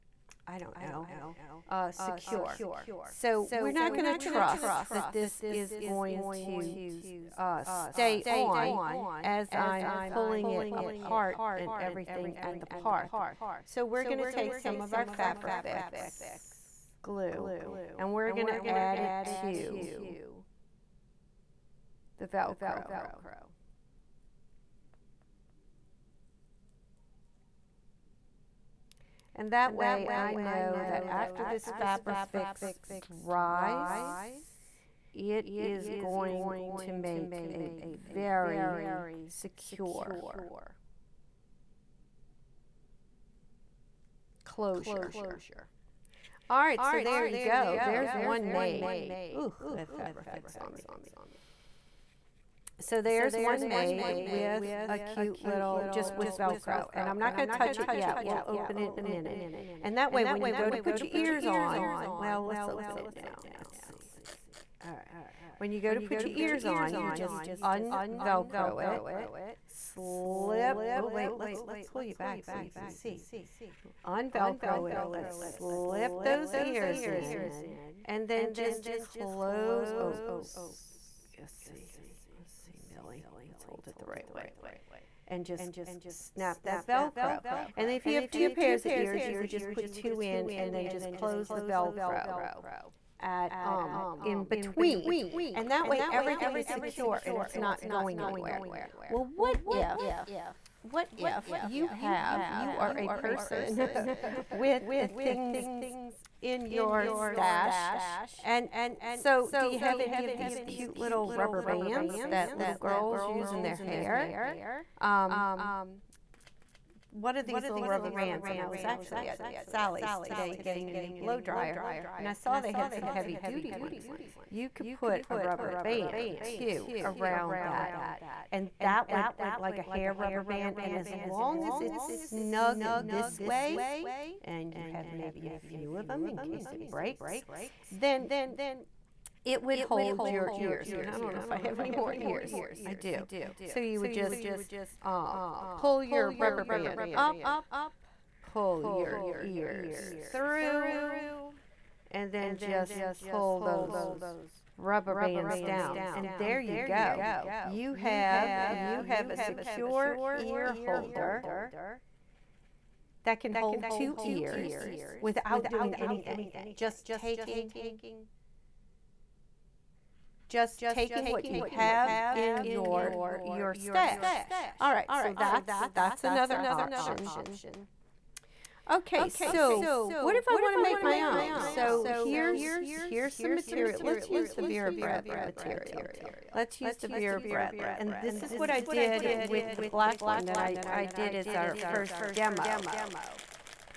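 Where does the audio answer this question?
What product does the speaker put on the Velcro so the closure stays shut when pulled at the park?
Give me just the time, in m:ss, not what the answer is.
0:15.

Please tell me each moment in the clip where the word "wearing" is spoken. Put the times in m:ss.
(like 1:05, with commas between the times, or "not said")
not said.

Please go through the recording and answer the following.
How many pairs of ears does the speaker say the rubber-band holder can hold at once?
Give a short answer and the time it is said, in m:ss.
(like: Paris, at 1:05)
2, at 2:43.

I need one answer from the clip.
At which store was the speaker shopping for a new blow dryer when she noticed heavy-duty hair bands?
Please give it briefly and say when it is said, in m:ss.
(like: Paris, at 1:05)
Sally's, at 1:59.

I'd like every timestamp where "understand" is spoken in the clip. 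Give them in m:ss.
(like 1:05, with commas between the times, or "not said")
not said.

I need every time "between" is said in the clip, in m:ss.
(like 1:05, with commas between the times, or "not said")
1:34.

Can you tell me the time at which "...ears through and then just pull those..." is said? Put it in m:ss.
2:29.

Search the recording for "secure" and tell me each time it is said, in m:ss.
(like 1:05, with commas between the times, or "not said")
0:01, 0:39, 1:36, 2:39.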